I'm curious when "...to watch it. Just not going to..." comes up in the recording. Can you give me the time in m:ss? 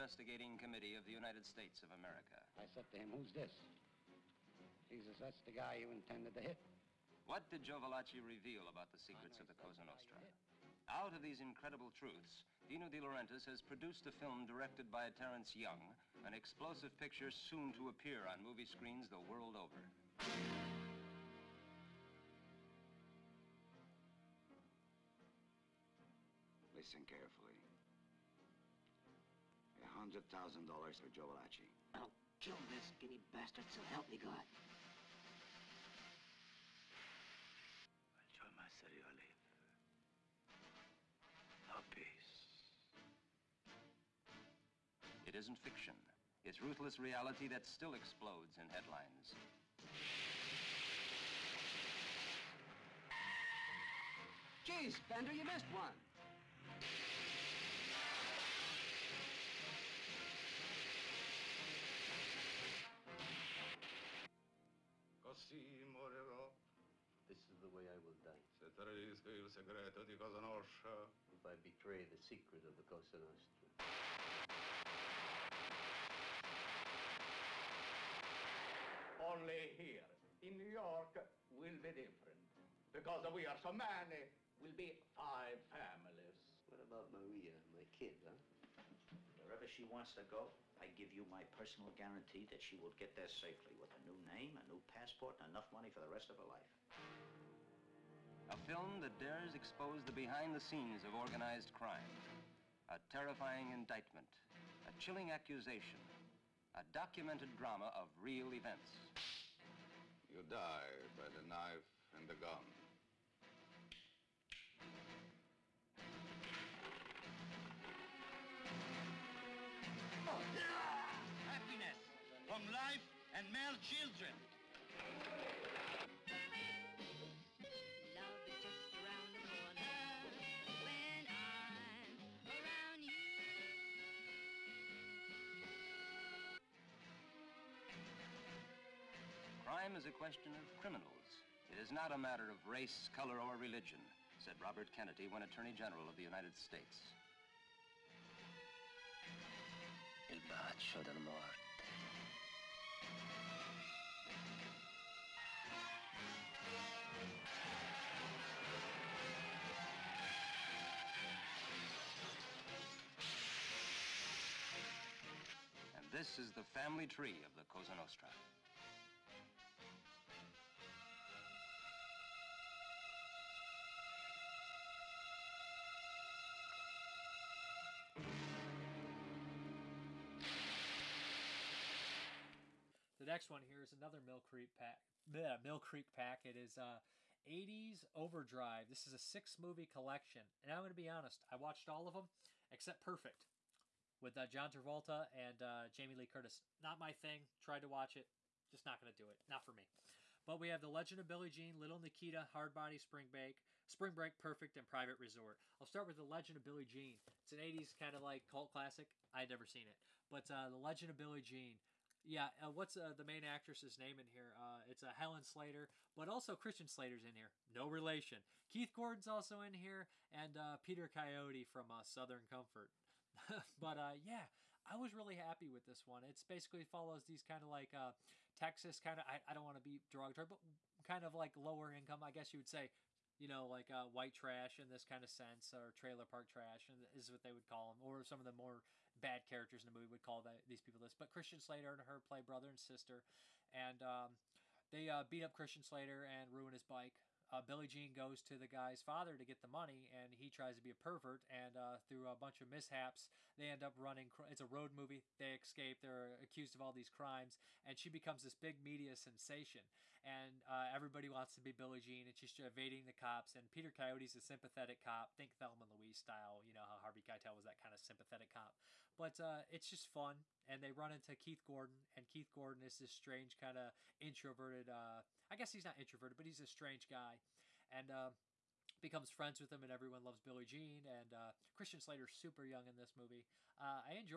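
3:17.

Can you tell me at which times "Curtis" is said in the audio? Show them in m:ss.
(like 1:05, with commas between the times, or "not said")
3:16.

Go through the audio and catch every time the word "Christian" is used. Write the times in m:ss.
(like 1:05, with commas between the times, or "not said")
3:36, 4:01, 4:05, 4:41.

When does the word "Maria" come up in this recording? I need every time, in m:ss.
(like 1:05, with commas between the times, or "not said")
1:27.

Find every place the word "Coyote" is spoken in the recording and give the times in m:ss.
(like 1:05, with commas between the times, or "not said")
3:41, 4:23.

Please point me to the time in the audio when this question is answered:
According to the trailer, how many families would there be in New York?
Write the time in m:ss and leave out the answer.
1:25.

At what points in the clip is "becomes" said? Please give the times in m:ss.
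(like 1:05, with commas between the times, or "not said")
4:18, 4:38.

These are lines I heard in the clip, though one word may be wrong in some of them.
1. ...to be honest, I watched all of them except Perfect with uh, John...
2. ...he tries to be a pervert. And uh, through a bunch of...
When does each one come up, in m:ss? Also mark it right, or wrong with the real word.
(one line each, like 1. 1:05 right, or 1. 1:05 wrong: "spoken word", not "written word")
1. 3:10 right
2. 4:10 right.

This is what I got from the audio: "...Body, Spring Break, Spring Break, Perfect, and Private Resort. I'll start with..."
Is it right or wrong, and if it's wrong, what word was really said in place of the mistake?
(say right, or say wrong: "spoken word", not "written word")
right.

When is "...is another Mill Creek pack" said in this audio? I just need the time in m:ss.
3:03.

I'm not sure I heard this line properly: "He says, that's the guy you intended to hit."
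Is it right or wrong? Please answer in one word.
right.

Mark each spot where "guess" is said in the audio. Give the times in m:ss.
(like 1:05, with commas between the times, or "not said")
3:52, 4:35.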